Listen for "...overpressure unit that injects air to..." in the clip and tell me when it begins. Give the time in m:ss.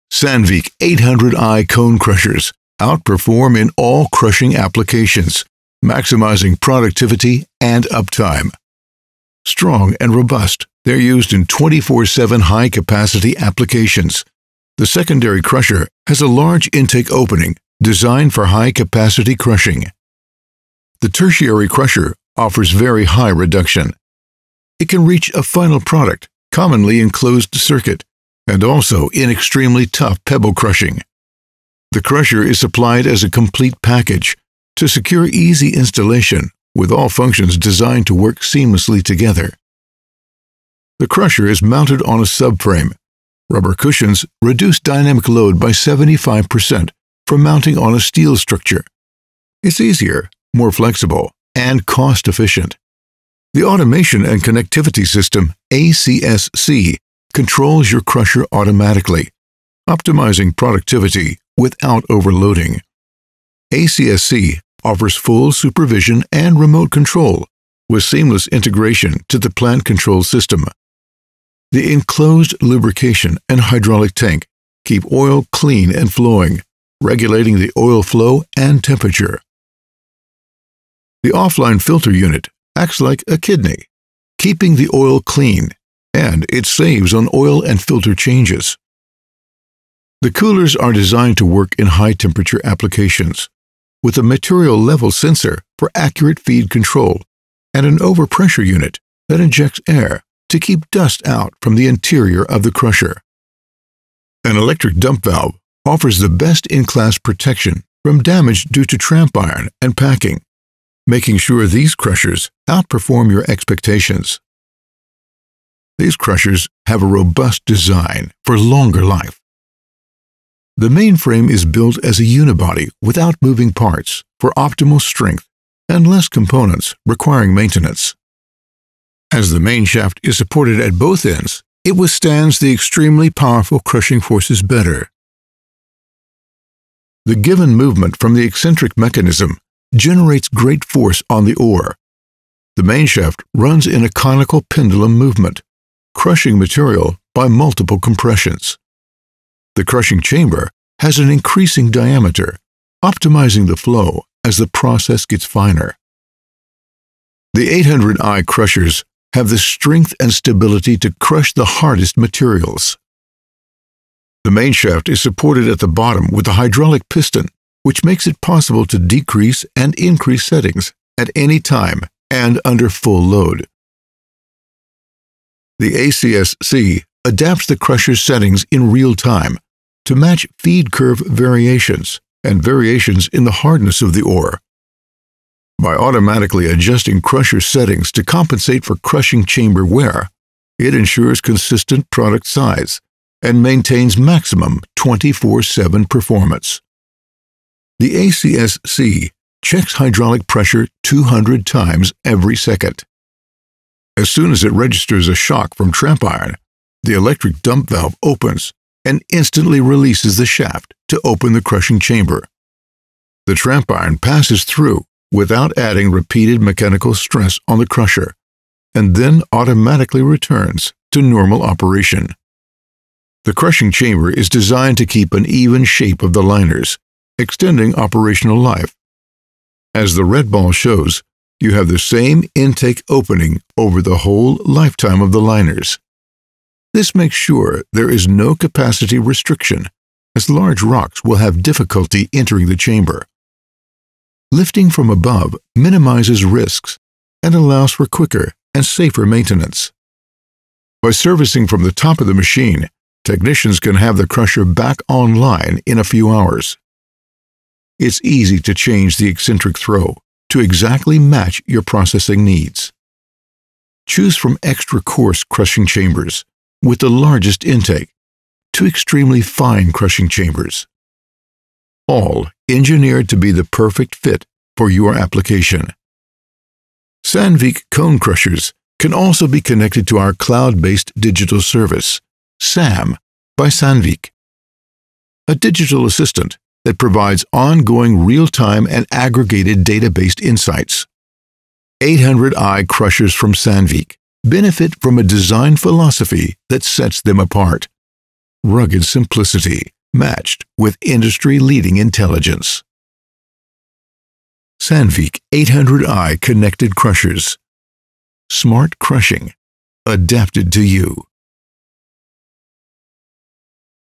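1:37.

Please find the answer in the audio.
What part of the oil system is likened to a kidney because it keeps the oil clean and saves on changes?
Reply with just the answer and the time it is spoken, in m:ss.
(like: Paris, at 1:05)
offline filter unit, at 1:21.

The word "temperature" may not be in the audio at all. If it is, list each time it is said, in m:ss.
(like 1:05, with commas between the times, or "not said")
1:18, 1:31.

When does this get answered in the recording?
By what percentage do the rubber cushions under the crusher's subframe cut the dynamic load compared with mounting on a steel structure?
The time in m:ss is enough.
0:45.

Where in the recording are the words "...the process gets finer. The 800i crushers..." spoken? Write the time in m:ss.
2:34.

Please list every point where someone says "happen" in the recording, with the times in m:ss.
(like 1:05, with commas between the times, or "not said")
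not said.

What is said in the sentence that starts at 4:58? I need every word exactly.
Rugged simplicity matched with industry leading intelligence.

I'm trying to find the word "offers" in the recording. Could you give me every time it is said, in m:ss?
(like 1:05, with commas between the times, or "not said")
0:22, 1:04, 1:45.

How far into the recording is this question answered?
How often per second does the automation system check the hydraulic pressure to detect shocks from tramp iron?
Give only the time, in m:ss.
3:21.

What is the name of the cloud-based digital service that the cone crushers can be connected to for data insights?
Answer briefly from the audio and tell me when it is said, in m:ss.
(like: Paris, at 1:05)
SAM, at 4:42.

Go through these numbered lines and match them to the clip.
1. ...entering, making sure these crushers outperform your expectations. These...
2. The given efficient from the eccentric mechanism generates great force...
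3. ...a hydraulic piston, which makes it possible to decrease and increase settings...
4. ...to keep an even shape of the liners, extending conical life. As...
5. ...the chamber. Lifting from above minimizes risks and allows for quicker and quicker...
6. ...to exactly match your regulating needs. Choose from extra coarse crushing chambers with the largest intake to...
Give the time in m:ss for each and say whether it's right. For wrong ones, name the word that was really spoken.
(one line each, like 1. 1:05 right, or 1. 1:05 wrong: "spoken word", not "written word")
1. 1:49 wrong: "packing", not "entering"
2. 2:17 wrong: "movement", not "efficient"
3. 2:46 right
4. 3:44 wrong: "operational", not "conical"
5. 4:02 wrong: "safer", not "quicker"
6. 4:20 wrong: "processing", not "regulating".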